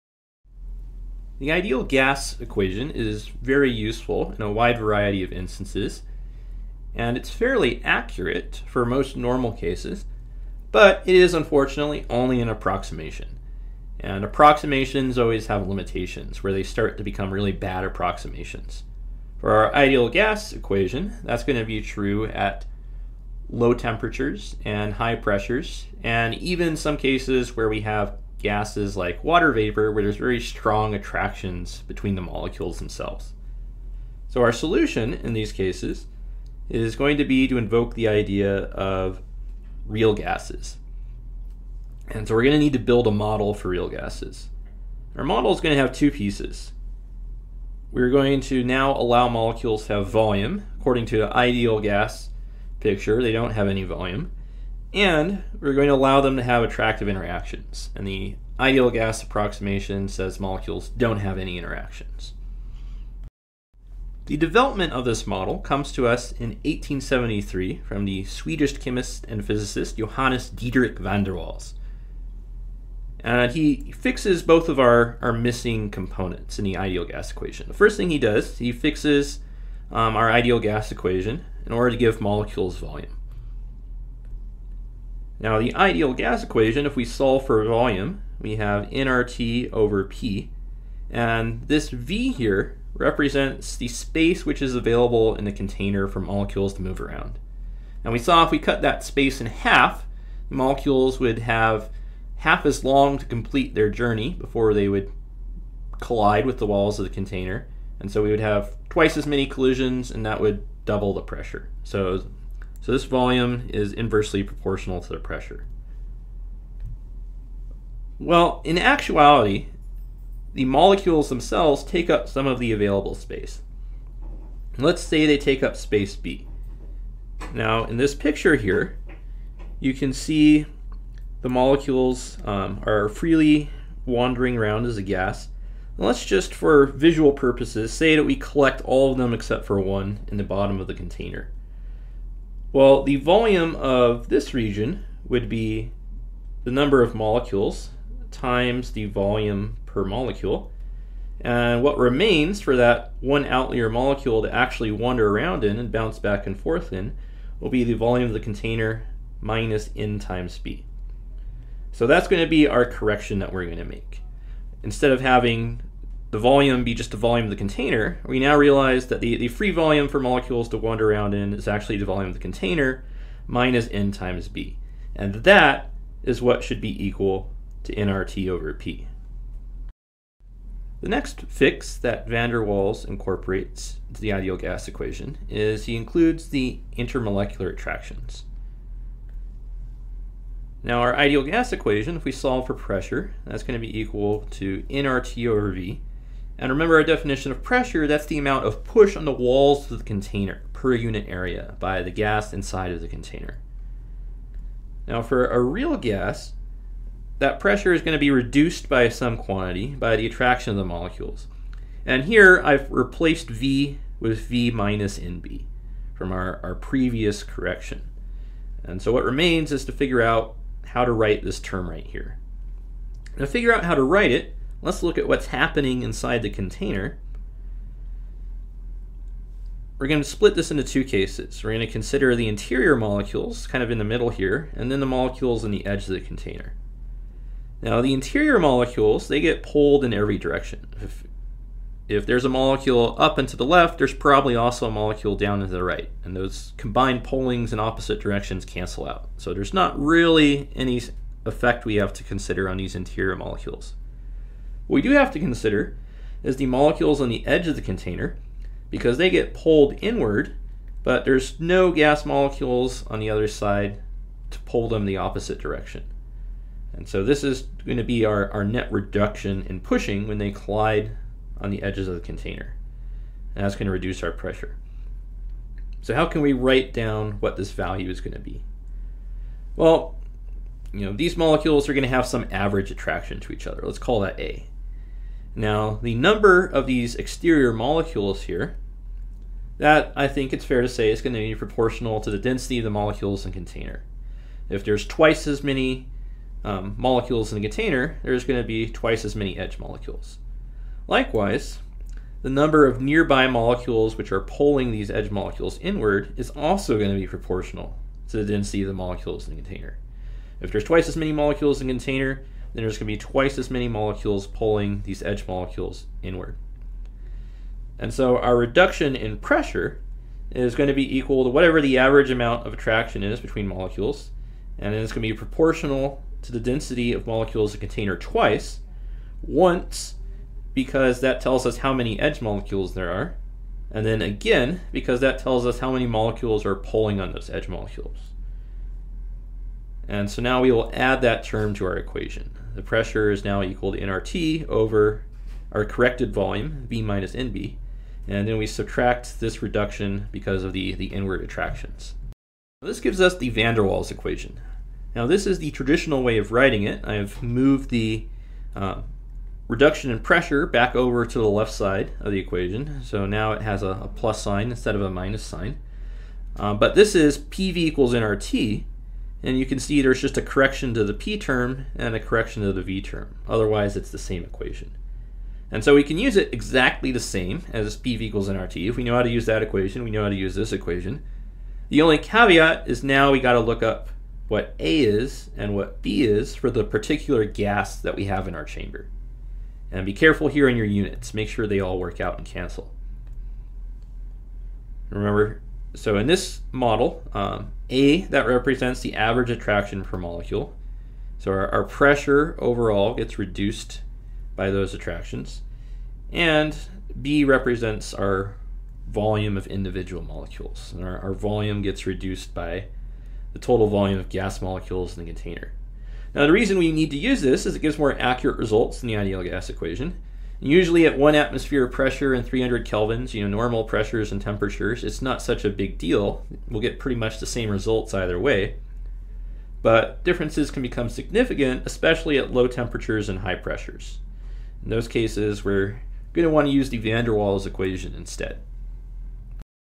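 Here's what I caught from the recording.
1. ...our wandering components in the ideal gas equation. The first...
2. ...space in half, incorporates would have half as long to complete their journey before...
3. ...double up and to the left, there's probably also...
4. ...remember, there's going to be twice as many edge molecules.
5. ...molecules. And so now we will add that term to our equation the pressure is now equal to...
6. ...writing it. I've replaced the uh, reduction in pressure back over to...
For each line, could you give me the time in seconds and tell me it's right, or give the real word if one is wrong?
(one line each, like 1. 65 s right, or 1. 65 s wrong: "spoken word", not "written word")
1. 75 s wrong: "missing", not "wandering"
2. 99 s wrong: "molecules", not "incorporates"
3. 242 s wrong: "molecule", not "double"
4. 297 s wrong: "container", not "remember"
5. 337 s right
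6. 356 s wrong: "moved", not "replaced".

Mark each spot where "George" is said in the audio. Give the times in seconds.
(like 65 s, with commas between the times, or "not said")
not said.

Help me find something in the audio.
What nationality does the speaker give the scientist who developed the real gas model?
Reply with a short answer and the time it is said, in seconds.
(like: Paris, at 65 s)
Swedish, at 68 s.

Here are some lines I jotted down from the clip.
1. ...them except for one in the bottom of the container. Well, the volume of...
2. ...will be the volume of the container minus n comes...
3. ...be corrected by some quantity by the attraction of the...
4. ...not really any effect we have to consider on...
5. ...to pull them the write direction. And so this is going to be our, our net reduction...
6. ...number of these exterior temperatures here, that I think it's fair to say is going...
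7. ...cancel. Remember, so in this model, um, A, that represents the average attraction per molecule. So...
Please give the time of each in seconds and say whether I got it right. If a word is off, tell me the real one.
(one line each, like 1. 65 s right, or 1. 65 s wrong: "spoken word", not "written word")
1. 139 s right
2. 157 s wrong: "times", not "comes"
3. 208 s wrong: "reduced", not "corrected"
4. 249 s right
5. 264 s wrong: "opposite", not "write"
6. 286 s wrong: "molecules", not "temperatures"
7. 392 s right.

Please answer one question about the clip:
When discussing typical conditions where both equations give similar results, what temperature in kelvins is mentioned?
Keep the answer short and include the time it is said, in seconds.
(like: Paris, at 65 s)
300 kelvins, at 422 s.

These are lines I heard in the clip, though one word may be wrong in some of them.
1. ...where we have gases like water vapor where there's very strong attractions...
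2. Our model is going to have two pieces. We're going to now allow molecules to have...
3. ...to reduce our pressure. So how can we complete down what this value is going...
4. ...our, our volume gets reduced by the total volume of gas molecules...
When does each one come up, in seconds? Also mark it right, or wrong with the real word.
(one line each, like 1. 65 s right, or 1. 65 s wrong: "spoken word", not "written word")
1. 27 s right
2. 45 s right
3. 273 s wrong: "write", not "complete"
4. 411 s right.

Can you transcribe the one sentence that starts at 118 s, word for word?
Well, in actuality, the molecules themselves take up some of the available space.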